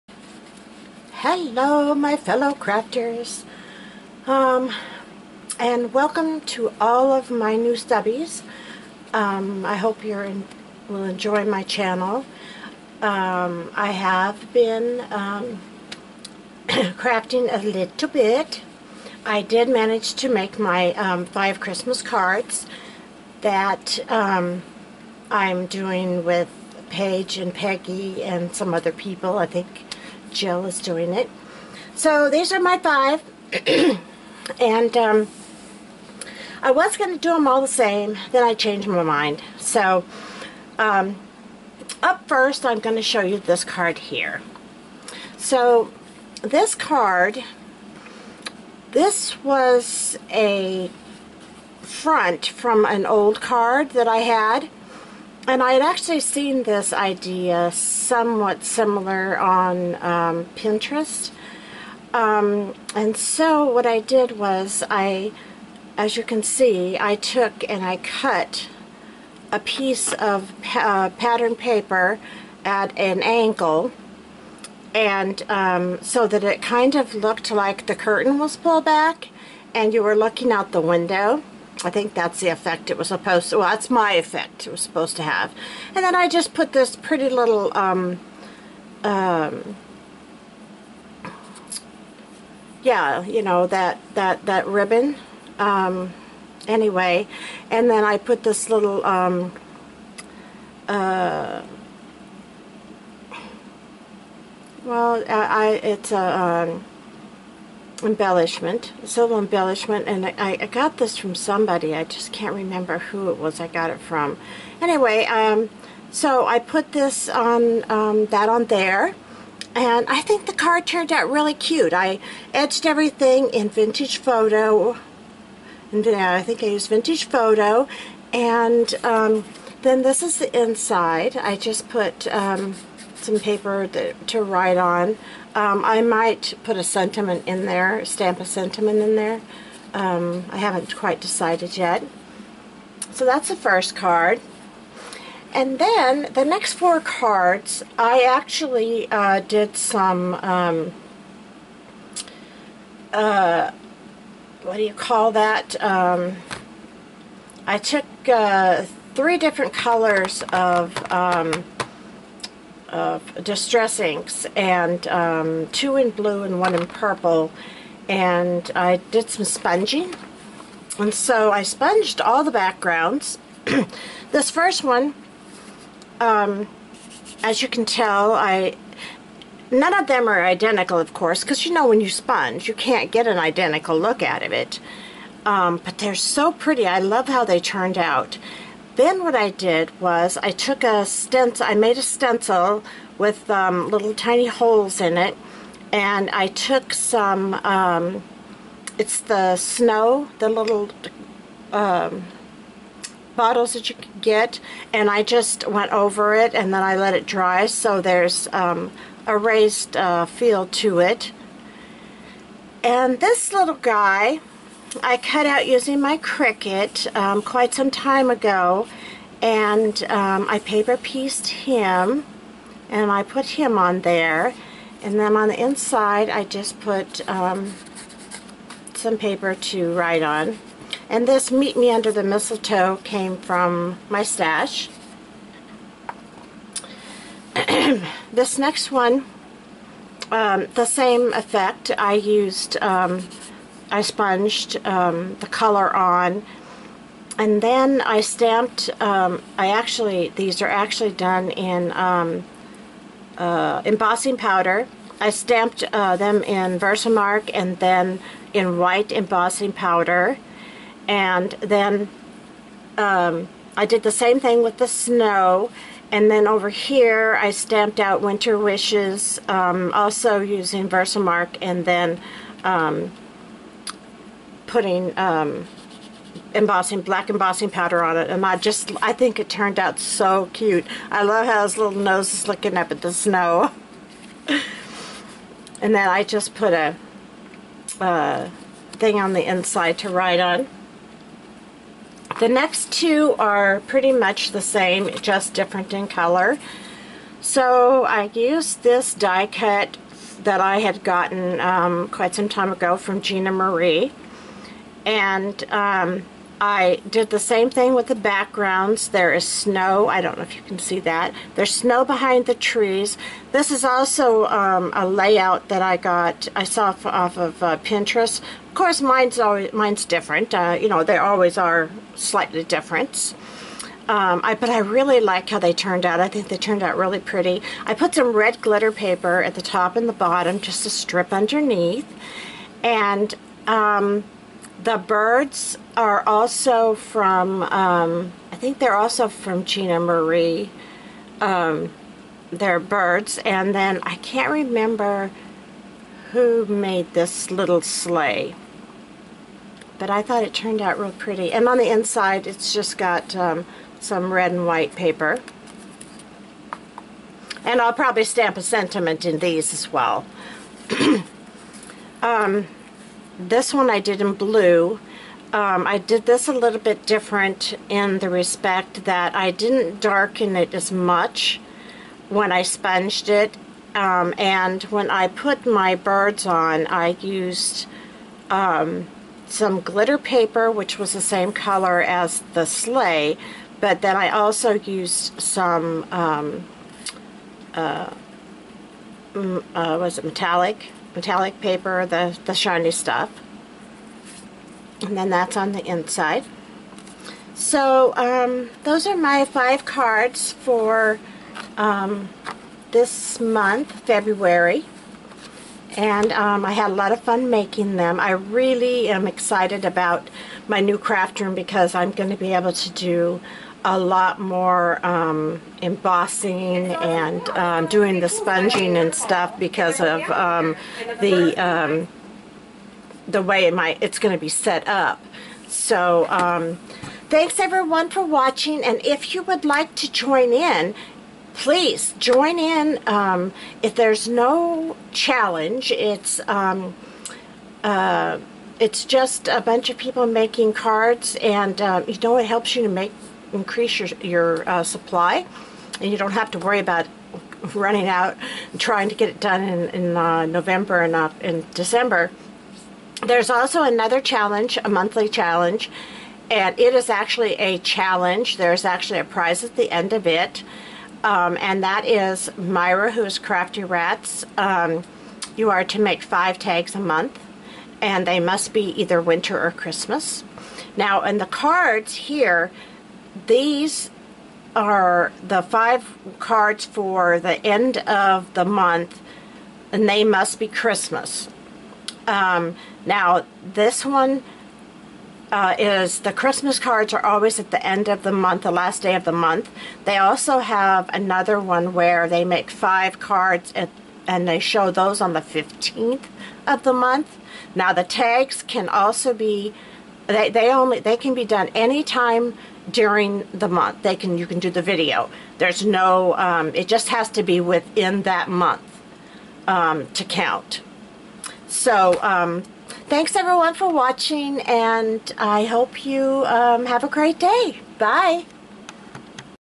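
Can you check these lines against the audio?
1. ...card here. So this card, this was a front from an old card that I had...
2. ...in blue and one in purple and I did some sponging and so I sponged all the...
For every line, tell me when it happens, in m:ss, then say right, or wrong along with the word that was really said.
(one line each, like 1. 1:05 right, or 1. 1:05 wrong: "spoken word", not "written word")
1. 0:43 right
2. 2:45 right.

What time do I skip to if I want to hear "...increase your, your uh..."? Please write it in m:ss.
7:23.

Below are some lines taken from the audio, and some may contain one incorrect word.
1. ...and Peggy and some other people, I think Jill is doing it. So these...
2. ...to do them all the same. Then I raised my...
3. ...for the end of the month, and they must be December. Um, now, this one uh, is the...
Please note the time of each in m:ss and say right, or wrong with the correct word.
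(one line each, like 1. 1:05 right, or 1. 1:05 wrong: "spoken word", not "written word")
1. 0:27 right
2. 0:37 wrong: "changed", not "raised"
3. 7:56 wrong: "Christmas", not "December".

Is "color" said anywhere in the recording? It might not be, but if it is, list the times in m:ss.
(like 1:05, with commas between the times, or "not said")
2:39, 4:05, 4:56, 6:21.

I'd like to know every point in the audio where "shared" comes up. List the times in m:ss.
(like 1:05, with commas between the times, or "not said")
not said.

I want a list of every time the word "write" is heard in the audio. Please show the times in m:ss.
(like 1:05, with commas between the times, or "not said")
2:14, 3:49, 4:50.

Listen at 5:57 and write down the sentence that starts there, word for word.
And I'll probably stamp a sentiment in these as well.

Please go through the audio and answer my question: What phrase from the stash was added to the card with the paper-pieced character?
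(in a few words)
Meet Me Under the Mistletoe.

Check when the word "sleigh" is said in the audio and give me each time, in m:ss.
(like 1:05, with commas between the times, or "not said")
5:47, 6:22.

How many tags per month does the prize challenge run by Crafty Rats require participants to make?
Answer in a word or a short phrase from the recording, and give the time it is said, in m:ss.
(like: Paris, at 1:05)
5, at 7:46.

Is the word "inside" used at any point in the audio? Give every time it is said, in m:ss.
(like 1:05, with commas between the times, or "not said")
2:10, 3:45, 4:49, 5:51, 6:35.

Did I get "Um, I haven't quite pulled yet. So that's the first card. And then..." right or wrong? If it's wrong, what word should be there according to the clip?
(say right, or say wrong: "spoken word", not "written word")
wrong: "decided", not "pulled".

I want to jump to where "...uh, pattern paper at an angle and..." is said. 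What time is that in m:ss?
1:10.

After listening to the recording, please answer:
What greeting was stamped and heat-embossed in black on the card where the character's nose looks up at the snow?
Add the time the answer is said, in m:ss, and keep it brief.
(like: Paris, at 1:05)
Winter Wishes, at 4:28.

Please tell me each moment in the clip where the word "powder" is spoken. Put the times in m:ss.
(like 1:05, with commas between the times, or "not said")
4:14, 4:19, 4:37.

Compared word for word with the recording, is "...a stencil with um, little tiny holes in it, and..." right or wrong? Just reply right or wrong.
right.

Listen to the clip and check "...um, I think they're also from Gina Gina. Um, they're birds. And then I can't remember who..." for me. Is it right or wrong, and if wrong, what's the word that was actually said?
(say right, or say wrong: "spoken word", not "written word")
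wrong: "Marie", not "Gina".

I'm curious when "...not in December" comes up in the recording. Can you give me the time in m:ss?
7:31.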